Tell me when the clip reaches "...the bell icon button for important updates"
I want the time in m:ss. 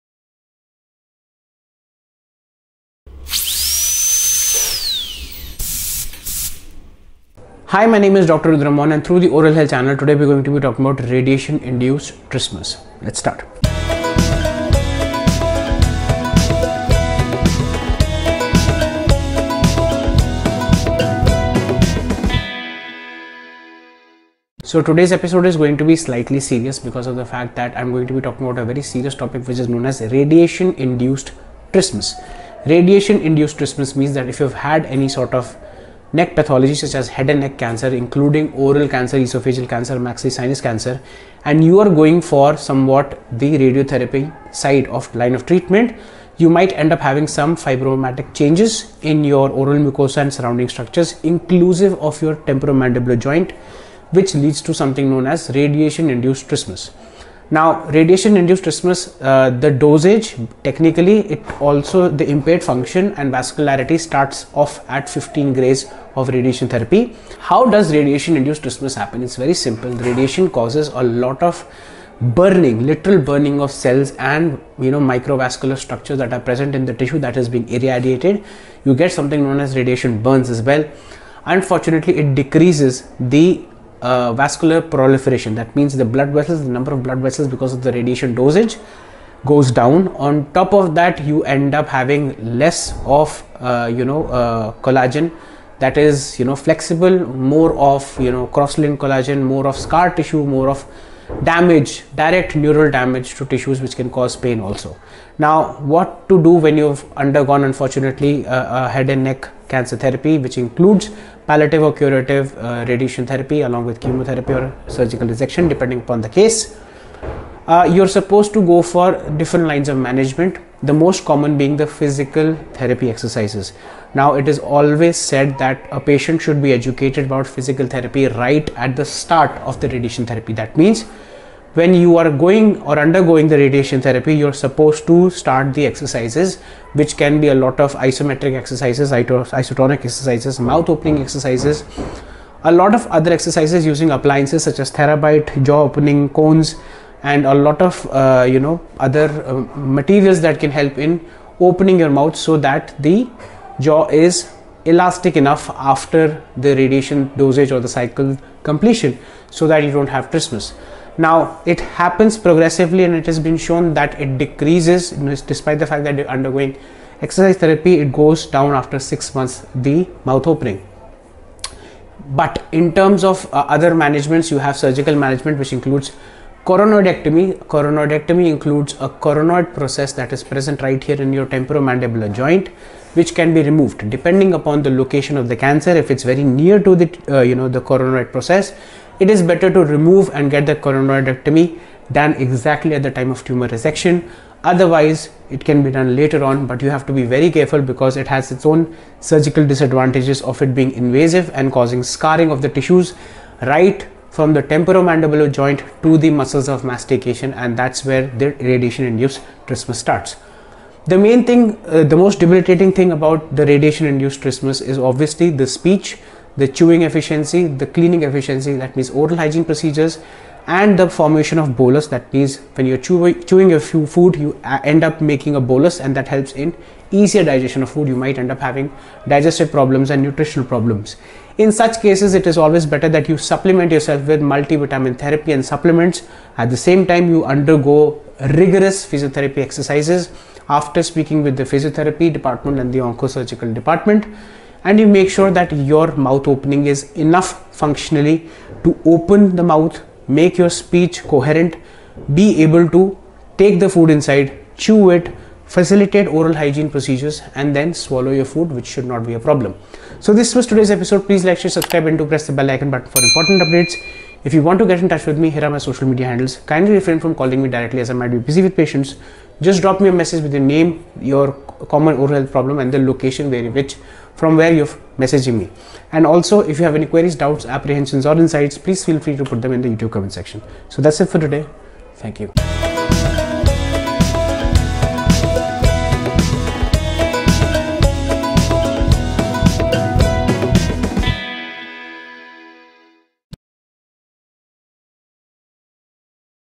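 4:22.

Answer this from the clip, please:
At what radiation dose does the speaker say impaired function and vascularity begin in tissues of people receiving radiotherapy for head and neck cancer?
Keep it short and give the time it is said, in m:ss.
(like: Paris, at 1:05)
15 grays, at 1:05.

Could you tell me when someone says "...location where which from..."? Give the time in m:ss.
4:32.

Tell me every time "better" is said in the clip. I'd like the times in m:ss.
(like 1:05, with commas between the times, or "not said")
3:09, 3:52.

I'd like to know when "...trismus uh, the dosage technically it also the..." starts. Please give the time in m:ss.
0:58.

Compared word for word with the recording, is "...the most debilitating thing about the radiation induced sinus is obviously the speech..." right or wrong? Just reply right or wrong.
wrong.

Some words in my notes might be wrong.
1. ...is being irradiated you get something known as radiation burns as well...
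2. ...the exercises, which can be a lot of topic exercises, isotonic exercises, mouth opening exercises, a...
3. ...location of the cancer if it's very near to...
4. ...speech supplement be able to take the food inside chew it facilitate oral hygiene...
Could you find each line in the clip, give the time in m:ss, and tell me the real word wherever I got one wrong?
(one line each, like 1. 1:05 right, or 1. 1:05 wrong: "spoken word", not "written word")
1. 1:17 right
2. 2:15 wrong: "isometric", not "topic"
3. 3:04 right
4. 4:10 wrong: "coherent", not "supplement".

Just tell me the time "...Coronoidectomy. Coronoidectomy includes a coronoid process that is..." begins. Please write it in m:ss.
2:56.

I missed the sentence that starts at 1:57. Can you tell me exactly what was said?
Uh, you're supposed to go for different lines of management the most common being the physical therapy exercises.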